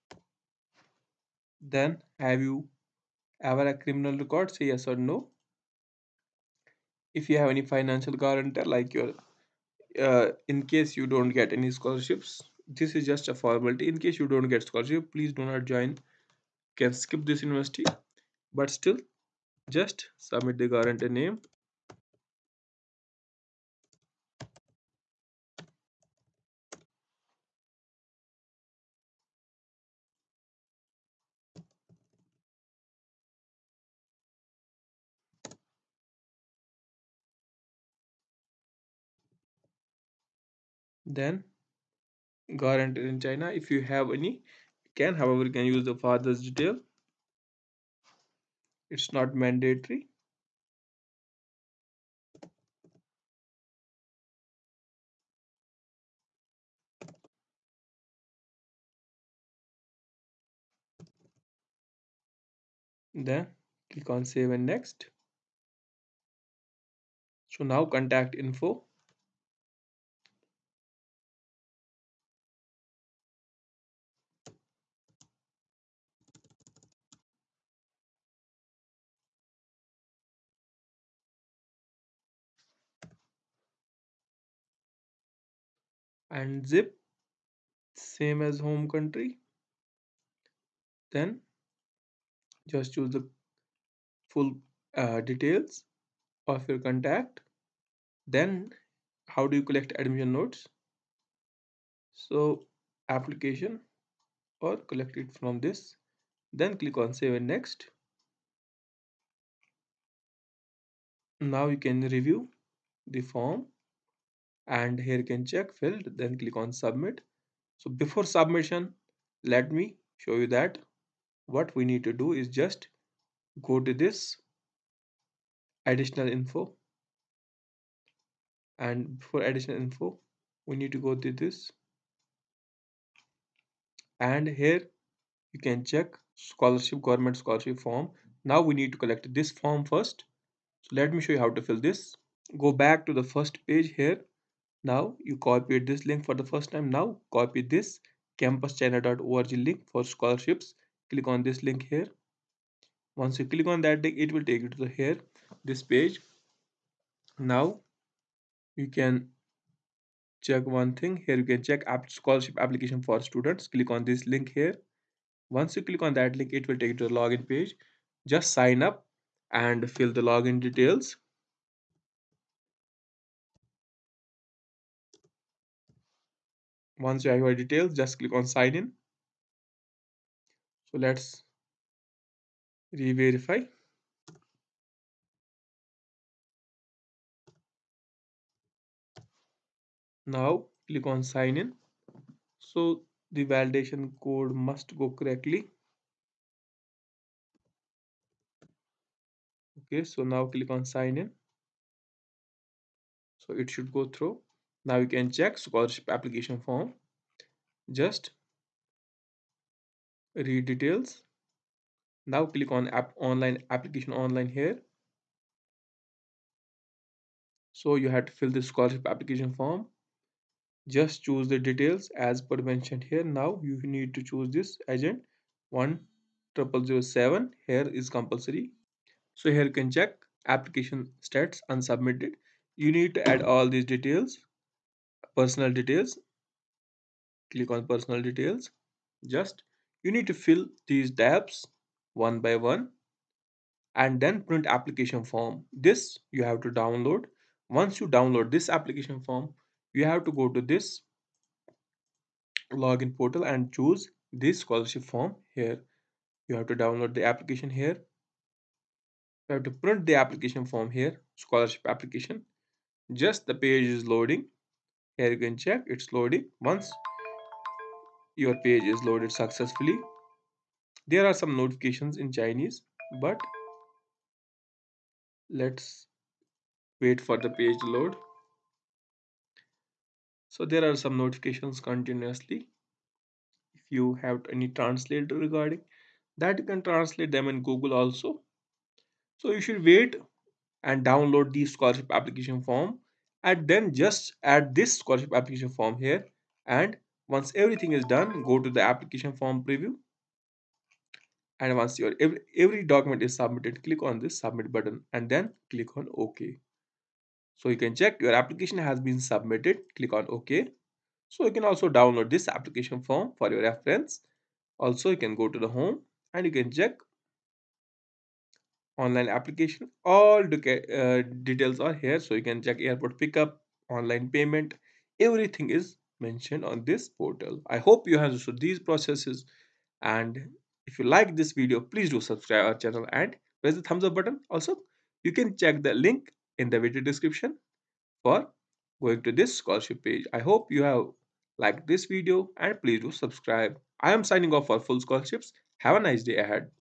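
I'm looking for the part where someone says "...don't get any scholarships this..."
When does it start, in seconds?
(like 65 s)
11 s.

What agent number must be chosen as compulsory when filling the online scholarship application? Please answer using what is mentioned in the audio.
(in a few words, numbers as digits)
1007.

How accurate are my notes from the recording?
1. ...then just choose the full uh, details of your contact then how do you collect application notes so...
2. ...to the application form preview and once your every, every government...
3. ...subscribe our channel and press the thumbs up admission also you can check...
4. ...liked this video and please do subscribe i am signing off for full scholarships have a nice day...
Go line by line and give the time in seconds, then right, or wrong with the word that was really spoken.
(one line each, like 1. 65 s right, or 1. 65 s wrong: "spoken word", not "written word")
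1. 91 s wrong: "admission", not "application"
2. 298 s wrong: "document", not "government"
3. 332 s wrong: "button", not "admission"
4. 341 s right.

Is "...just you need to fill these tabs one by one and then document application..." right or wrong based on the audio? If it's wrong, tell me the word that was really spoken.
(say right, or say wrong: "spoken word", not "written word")
wrong: "print", not "document".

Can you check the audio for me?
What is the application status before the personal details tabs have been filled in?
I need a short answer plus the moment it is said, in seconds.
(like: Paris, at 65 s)
Unsubmitted, at 231 s.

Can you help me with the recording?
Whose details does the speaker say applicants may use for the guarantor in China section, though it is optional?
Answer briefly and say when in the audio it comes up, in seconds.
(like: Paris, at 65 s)
Father's, at 45 s.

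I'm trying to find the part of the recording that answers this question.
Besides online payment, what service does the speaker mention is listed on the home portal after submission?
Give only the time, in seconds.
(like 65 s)
322 s.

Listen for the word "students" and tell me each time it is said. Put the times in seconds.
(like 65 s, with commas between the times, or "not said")
163 s.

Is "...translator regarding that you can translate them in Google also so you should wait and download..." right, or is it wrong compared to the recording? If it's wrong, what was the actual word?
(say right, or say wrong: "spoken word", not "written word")
right.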